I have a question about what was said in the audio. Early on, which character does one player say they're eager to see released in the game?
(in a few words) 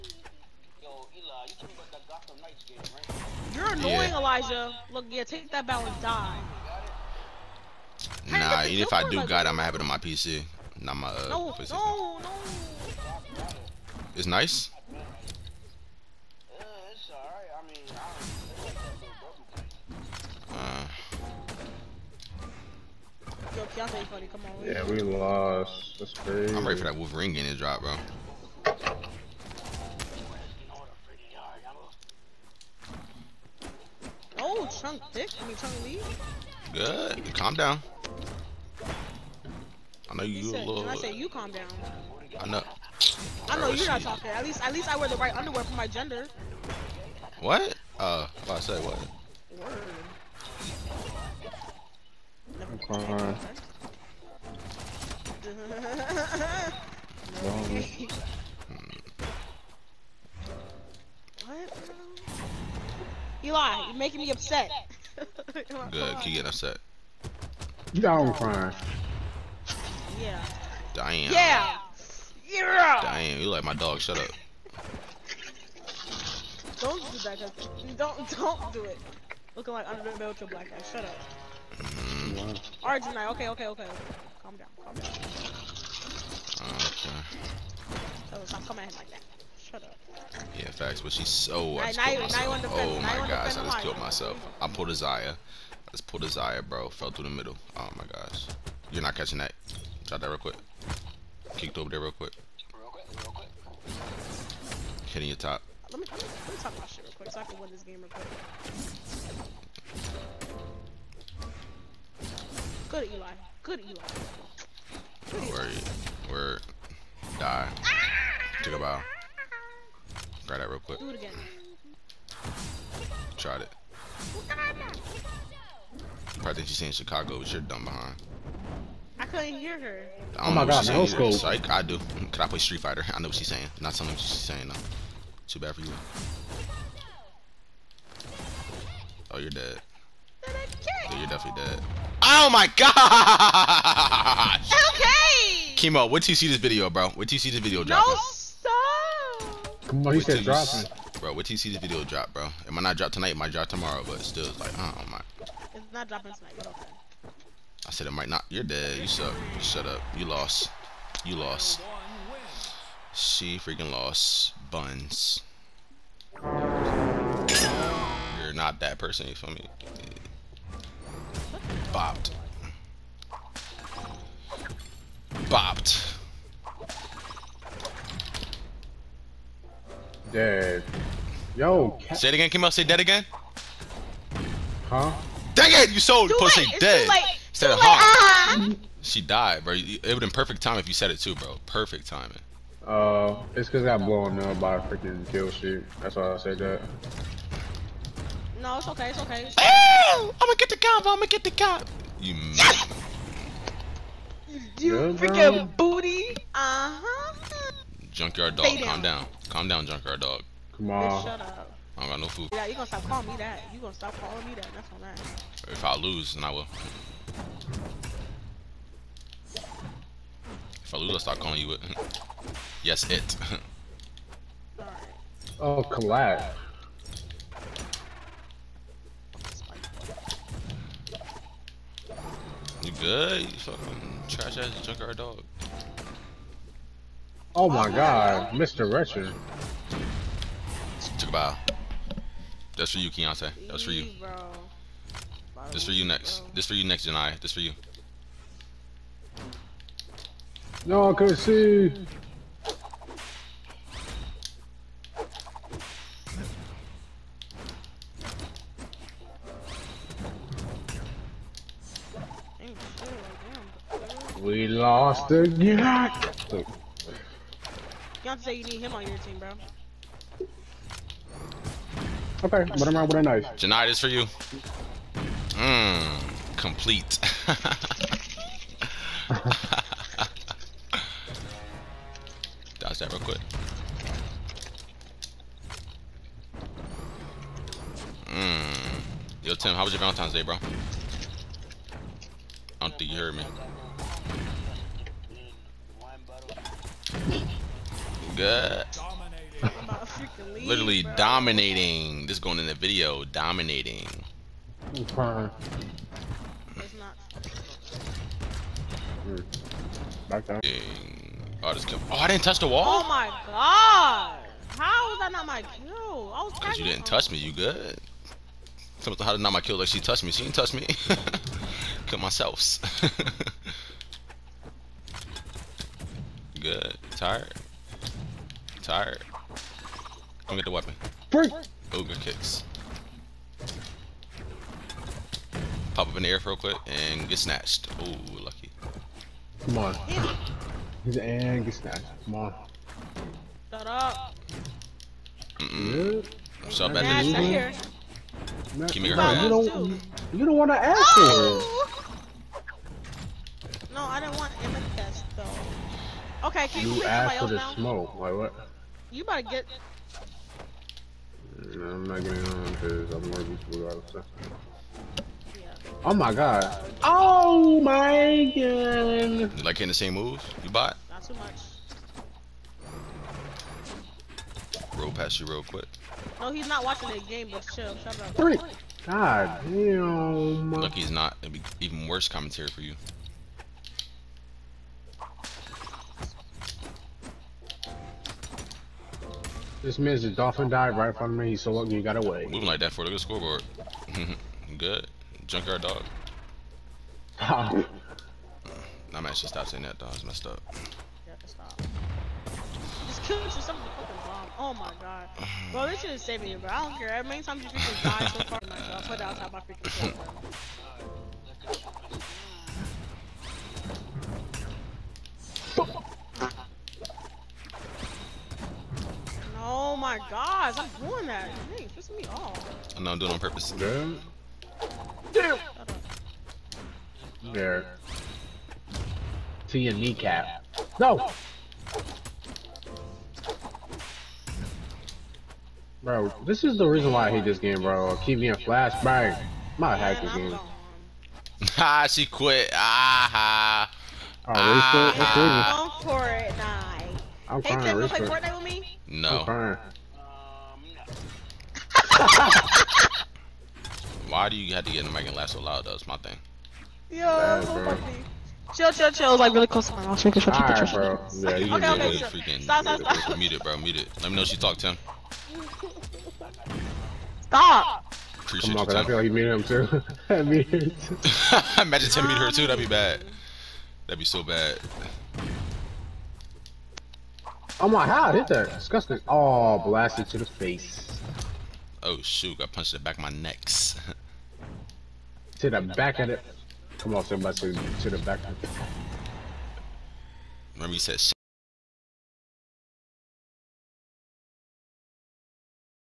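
Wolverine.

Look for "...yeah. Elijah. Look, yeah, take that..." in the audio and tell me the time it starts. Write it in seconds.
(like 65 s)
4 s.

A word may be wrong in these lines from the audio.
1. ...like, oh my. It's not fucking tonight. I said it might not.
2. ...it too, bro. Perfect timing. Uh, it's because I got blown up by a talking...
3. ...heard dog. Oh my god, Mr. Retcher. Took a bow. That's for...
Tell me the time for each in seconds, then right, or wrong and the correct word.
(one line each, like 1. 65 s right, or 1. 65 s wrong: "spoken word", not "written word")
1. 154 s wrong: "dropping", not "fucking"
2. 191 s wrong: "freaking", not "talking"
3. 234 s wrong: "junkyard", not "heard".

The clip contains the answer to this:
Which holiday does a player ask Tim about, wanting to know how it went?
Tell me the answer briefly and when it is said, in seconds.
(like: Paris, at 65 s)
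Valentine's Day, at 289 s.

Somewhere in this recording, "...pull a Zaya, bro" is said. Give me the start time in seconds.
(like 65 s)
96 s.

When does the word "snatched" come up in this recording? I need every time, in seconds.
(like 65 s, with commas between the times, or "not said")
337 s, 341 s.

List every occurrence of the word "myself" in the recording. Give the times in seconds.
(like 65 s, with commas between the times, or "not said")
93 s, 322 s.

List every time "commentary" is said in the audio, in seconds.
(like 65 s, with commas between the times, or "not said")
382 s.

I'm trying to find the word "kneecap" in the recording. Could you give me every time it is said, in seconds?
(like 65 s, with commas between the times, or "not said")
429 s.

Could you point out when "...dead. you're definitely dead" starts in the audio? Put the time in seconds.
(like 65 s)
139 s.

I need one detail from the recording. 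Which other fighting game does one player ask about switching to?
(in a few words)
Street Fighter.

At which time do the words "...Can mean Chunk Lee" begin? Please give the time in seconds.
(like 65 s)
35 s.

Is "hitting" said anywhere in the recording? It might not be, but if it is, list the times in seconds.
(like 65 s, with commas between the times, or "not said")
105 s, 369 s.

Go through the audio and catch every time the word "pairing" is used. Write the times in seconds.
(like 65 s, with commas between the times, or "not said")
not said.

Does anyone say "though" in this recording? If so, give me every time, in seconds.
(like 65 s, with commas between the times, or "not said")
355 s, 455 s.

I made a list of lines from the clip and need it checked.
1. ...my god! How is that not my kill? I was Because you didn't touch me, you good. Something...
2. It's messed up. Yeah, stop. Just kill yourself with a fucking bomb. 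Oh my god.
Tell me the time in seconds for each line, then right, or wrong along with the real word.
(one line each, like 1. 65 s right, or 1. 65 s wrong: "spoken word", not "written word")
1. 313 s right
2. 400 s right.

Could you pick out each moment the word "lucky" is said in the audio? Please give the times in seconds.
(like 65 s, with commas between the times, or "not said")
338 s, 391 s.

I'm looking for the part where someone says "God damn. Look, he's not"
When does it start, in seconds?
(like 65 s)
379 s.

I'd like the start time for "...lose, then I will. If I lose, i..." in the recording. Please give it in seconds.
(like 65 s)
215 s.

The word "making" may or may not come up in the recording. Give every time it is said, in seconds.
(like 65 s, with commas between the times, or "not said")
63 s, 460 s.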